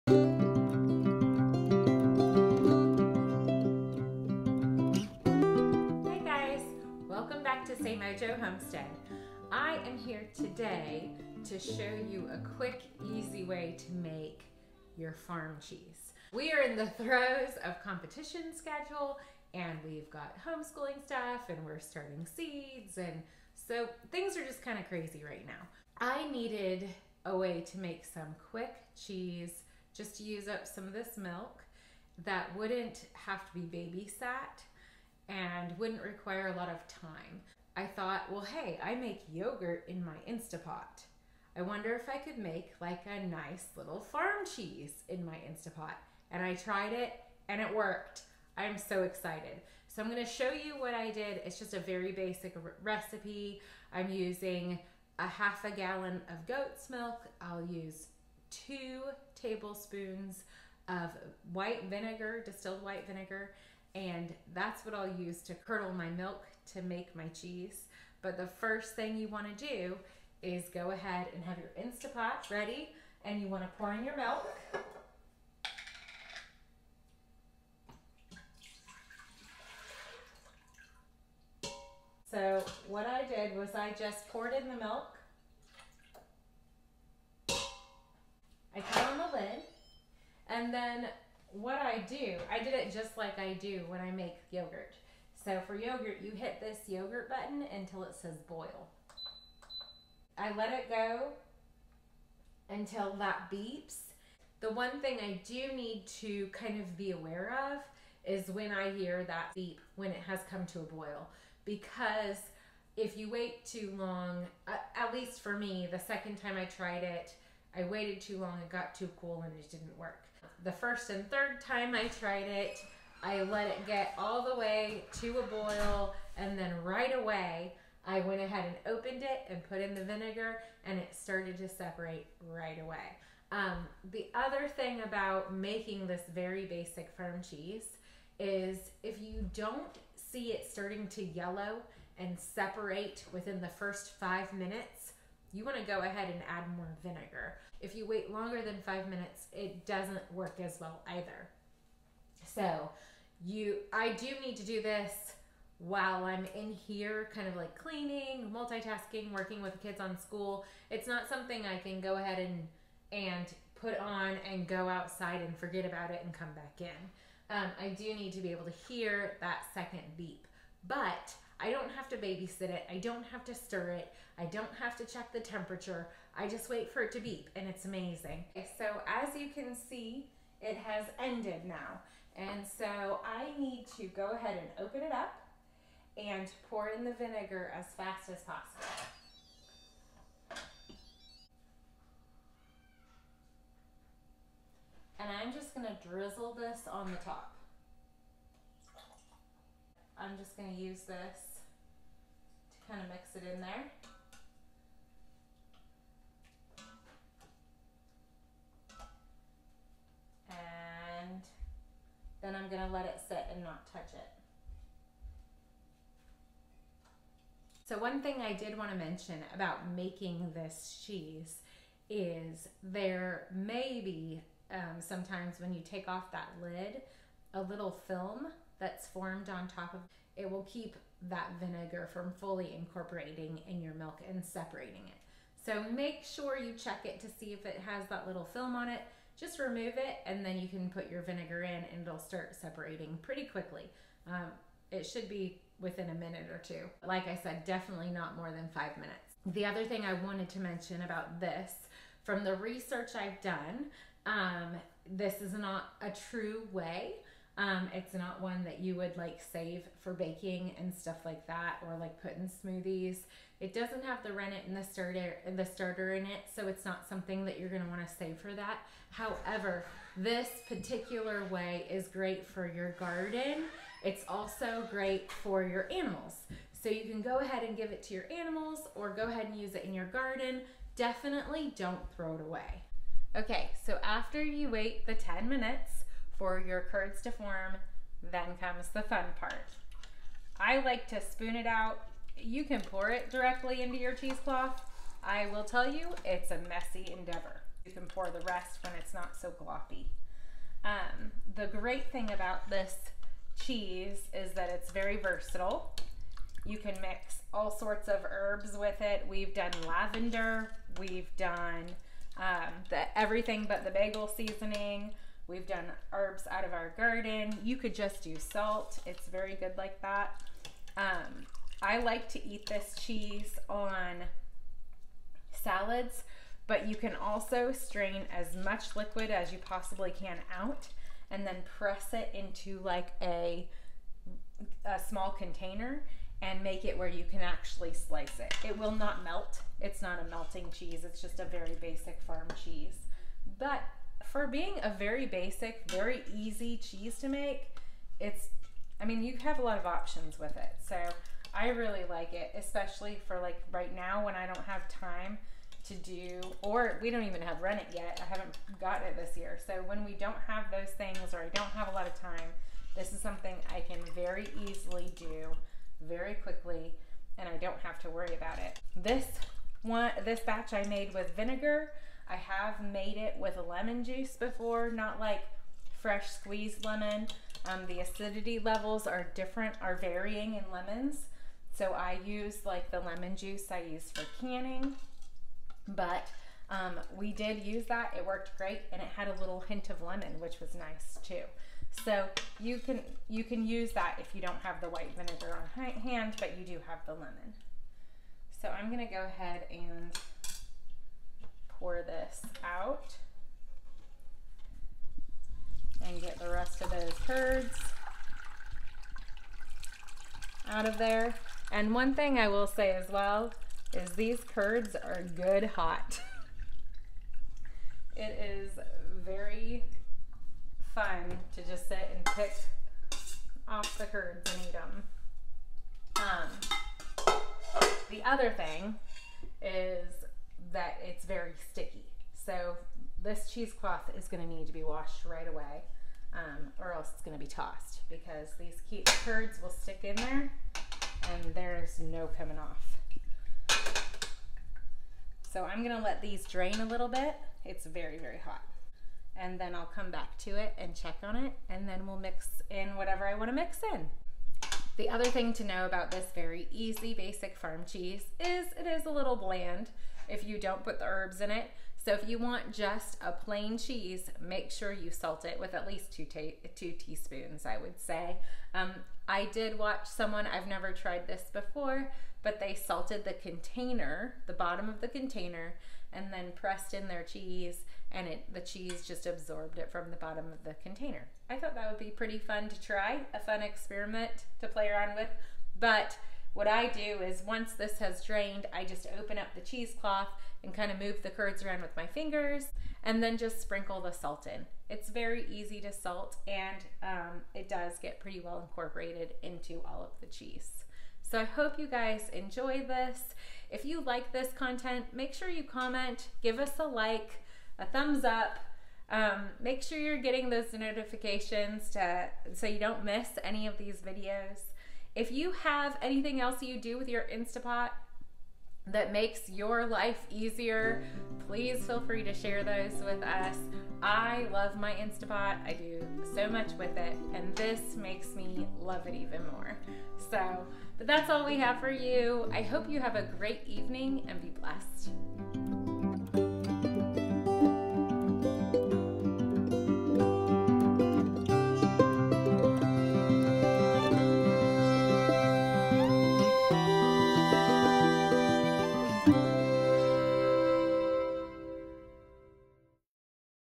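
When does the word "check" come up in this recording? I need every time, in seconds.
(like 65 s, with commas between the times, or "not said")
175 s, 236 s, 450 s.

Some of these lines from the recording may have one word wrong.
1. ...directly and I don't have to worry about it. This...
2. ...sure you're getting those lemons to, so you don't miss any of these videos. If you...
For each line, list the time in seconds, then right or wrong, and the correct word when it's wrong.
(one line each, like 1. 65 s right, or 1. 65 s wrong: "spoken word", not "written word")
1. 366 s wrong: "quickly", not "directly"
2. 509 s wrong: "notifications", not "lemons".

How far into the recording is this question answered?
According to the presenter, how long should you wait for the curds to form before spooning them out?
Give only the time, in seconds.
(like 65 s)
285 s.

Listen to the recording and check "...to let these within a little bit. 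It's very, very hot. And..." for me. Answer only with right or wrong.
wrong.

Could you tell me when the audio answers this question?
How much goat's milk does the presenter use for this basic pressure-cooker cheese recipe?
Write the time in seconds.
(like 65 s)
55 s.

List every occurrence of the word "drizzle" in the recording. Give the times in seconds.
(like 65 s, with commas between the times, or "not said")
196 s.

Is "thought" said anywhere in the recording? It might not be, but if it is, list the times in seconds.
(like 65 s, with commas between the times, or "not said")
37 s, 481 s.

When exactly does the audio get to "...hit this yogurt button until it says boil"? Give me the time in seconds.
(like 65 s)
96 s.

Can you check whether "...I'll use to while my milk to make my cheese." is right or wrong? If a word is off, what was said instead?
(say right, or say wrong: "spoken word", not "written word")
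wrong: "curdle", not "while".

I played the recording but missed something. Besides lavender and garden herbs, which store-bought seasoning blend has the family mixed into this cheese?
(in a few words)
everything but the bagel.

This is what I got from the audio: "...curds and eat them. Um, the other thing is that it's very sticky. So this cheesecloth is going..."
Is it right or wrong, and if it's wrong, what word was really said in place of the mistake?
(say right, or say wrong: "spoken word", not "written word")
right.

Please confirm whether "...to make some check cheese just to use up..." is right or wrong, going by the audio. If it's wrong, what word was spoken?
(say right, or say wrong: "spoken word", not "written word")
wrong: "quick", not "check".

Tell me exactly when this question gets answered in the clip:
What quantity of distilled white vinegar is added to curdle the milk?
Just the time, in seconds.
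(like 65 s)
58 s.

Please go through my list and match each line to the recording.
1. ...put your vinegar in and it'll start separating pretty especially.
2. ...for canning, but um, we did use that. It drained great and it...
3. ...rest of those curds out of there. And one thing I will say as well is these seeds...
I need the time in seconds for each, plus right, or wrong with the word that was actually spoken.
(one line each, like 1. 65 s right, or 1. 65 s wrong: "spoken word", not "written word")
1. 240 s wrong: "quickly", not "especially"
2. 384 s wrong: "worked", not "drained"
3. 406 s wrong: "curds", not "seeds".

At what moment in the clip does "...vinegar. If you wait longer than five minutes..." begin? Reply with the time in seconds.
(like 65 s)
147 s.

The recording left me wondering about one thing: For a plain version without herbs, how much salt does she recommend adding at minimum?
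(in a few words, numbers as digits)
2 teaspoons.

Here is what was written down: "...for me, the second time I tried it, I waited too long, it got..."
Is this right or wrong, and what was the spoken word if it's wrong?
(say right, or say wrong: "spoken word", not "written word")
right.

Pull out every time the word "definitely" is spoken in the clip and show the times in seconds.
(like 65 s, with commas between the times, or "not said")
247 s, 280 s.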